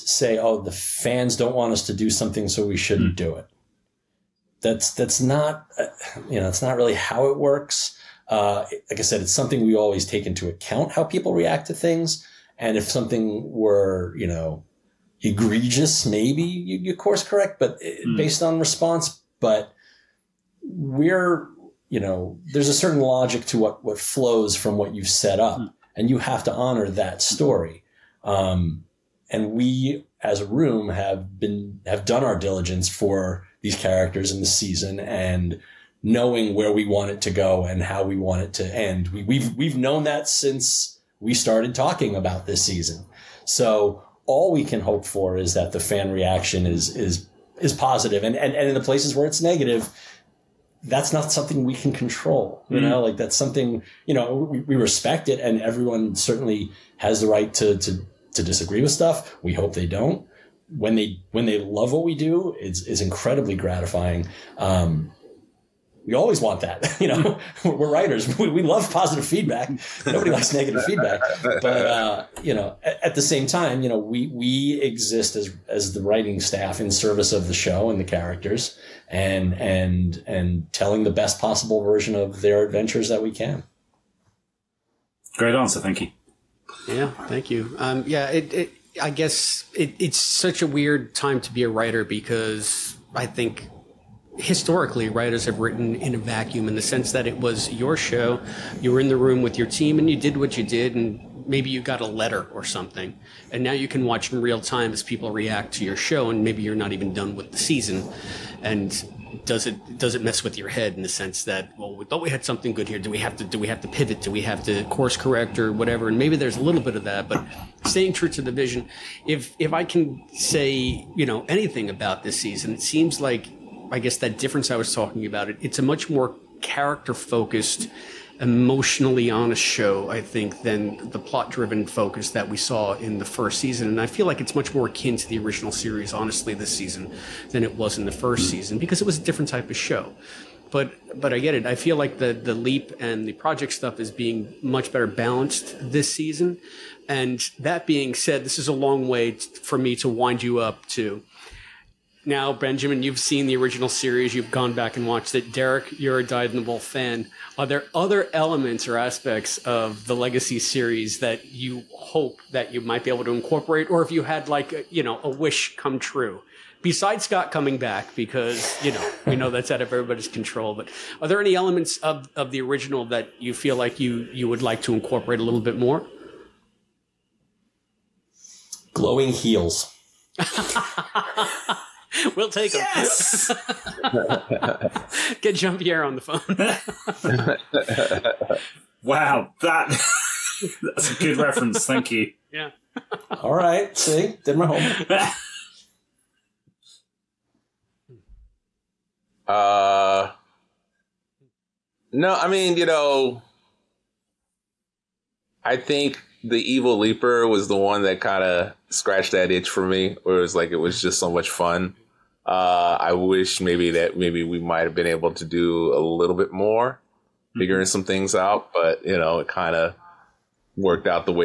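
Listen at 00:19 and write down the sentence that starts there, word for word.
But we're you know, there's a certain logic to what, what flows from what you've set up, mm-hmm.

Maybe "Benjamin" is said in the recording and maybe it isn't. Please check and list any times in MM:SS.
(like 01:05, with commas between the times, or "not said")
02:32.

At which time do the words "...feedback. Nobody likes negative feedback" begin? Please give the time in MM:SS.
01:09.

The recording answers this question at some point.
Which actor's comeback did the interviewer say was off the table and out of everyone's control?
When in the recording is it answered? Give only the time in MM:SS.
02:47.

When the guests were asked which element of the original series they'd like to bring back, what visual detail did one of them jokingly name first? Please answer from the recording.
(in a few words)
Glowing heels.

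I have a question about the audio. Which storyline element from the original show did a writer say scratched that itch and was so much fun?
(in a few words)
The evil leaper.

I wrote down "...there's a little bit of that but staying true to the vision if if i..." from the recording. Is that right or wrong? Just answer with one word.
right.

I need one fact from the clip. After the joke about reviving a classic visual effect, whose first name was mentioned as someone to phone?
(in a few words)
Jean Pierre.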